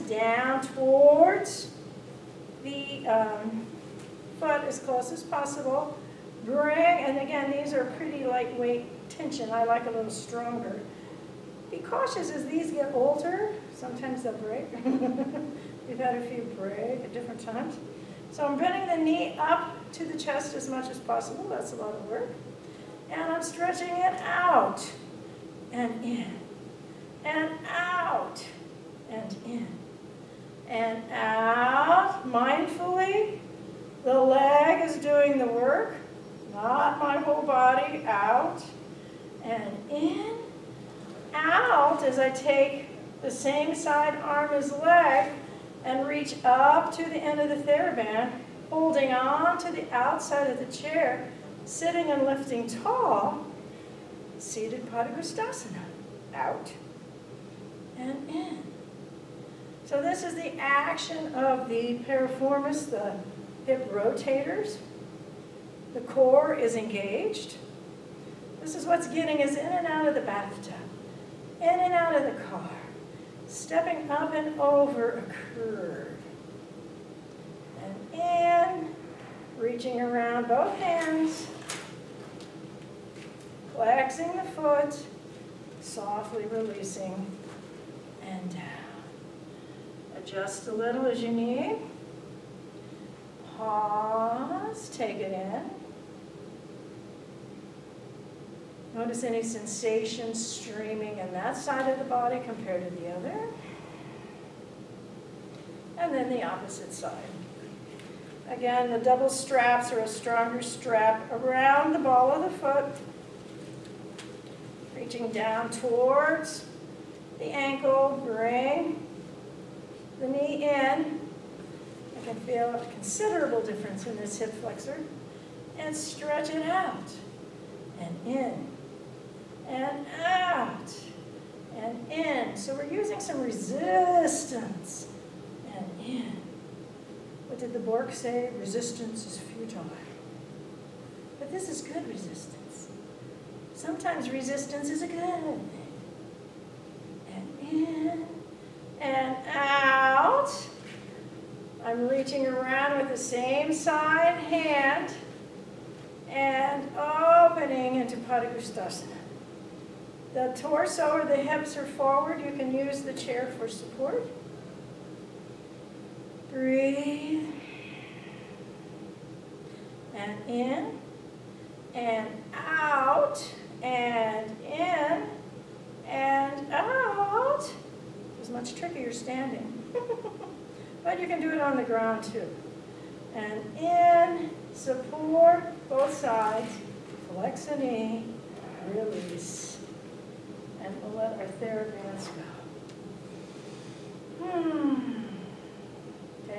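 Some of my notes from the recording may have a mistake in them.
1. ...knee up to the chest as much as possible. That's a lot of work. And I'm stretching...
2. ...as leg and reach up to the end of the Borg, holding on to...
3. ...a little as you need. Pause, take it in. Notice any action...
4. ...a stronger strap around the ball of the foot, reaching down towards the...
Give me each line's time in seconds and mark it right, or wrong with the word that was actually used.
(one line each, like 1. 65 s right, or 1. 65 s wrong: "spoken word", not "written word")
1. 19 s right
2. 44 s wrong: "TheraBand", not "Borg"
3. 90 s wrong: "sensation", not "action"
4. 110 s right.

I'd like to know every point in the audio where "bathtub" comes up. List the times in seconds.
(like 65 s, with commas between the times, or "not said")
70 s.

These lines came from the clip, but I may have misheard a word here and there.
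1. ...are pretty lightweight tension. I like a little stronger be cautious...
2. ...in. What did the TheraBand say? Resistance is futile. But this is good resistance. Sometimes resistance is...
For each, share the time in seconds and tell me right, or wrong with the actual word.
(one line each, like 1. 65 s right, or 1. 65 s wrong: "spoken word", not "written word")
1. 7 s right
2. 136 s wrong: "Borg", not "TheraBand".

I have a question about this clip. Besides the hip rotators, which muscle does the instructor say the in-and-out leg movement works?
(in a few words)
Piriformis.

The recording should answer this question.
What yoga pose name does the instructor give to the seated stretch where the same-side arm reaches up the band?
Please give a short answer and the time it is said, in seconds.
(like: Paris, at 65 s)
Seated Padangusthasana, at 54 s.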